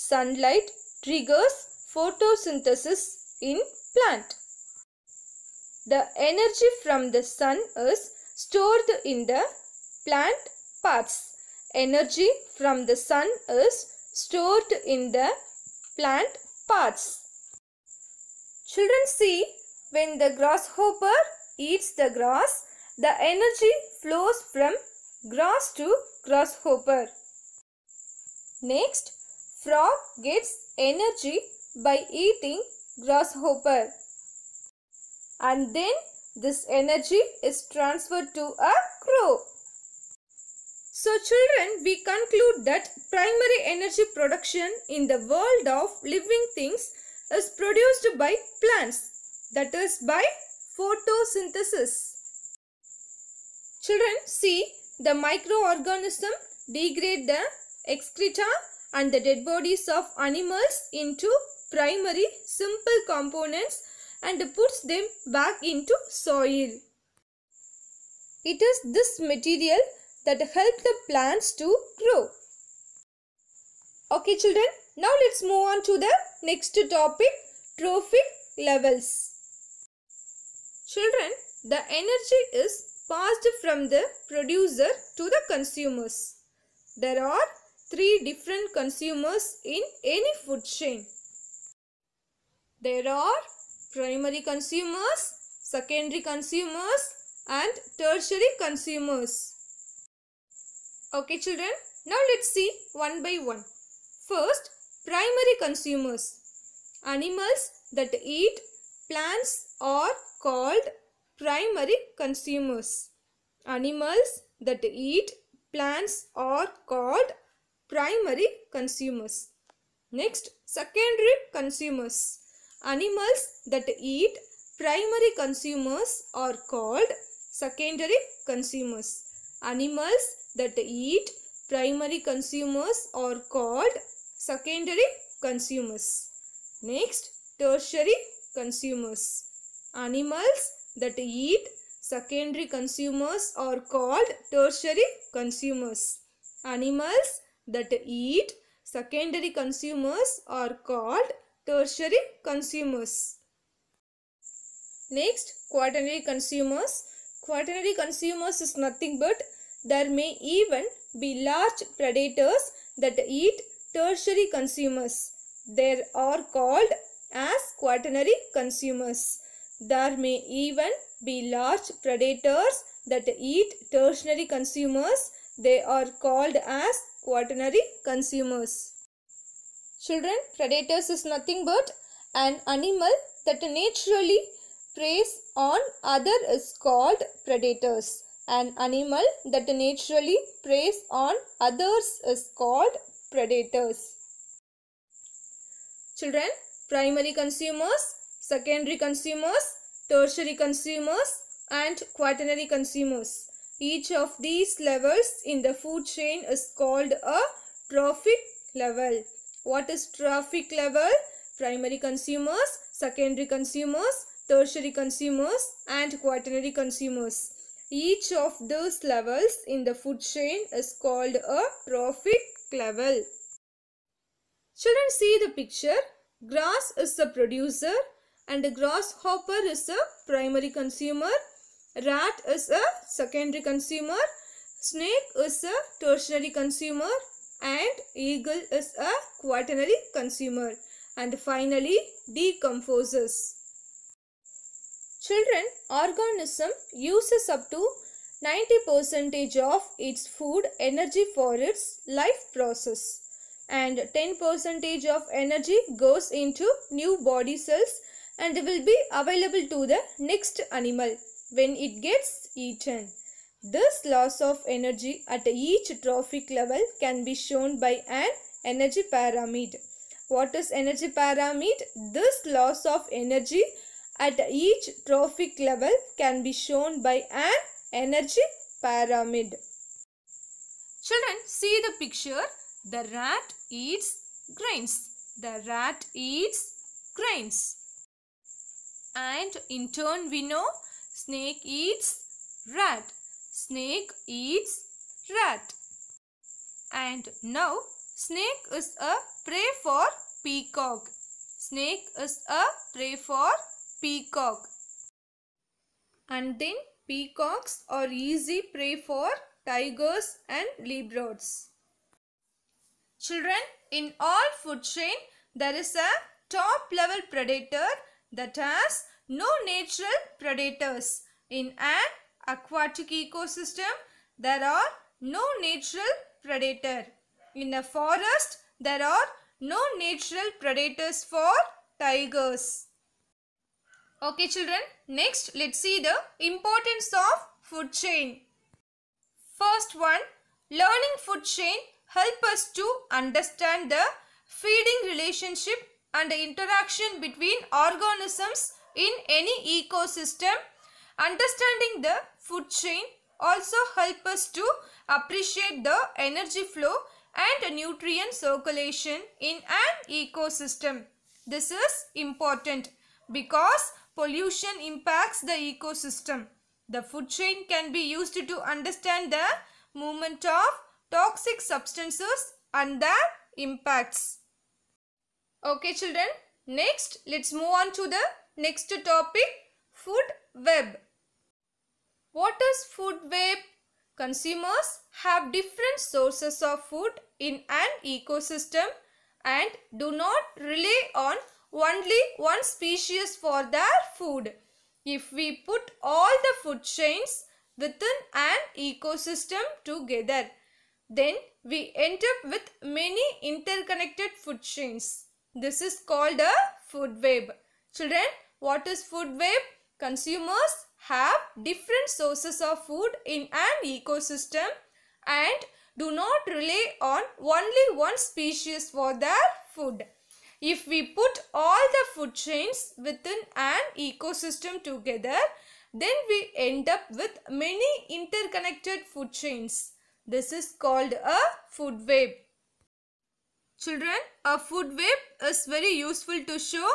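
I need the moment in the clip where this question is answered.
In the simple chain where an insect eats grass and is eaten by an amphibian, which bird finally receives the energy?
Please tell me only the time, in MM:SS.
00:39.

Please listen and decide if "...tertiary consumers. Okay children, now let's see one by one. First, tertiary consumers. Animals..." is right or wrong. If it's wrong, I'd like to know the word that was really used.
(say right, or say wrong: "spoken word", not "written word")
wrong: "primary", not "tertiary".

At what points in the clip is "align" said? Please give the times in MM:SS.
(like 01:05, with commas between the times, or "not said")
not said.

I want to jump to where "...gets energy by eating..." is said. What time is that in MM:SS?
00:30.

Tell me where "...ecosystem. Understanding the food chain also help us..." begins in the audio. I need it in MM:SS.
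05:49.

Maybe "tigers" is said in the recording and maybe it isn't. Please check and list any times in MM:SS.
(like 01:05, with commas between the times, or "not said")
05:09, 05:31.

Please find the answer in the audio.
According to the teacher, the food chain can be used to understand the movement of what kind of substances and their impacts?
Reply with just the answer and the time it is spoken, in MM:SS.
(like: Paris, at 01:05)
Toxic substances, at 06:11.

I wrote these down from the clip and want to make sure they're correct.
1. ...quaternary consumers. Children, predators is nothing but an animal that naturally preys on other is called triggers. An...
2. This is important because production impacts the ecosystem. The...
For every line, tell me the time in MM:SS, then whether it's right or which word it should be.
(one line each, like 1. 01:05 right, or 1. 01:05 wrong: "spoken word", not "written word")
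1. 02:57 wrong: "predators", not "triggers"
2. 06:01 wrong: "pollution", not "production".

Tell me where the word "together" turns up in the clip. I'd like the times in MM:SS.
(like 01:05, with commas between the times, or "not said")
06:39, 07:04.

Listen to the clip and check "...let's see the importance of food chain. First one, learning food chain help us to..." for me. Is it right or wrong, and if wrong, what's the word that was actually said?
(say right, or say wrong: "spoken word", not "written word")
right.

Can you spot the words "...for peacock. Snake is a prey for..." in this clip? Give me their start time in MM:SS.
04:59.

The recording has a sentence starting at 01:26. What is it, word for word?
There are three different consumers in any food chain.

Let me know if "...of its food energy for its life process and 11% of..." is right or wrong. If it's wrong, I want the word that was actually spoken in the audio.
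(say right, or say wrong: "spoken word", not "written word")
wrong: "10", not "11".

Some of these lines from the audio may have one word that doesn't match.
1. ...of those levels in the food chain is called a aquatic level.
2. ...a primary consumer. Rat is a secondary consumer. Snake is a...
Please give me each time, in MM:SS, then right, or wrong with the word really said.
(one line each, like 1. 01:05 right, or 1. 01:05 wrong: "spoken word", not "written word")
1. 03:38 wrong: "trophic", not "aquatic"
2. 03:49 right.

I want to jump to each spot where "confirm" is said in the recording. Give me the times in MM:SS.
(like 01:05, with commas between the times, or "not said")
not said.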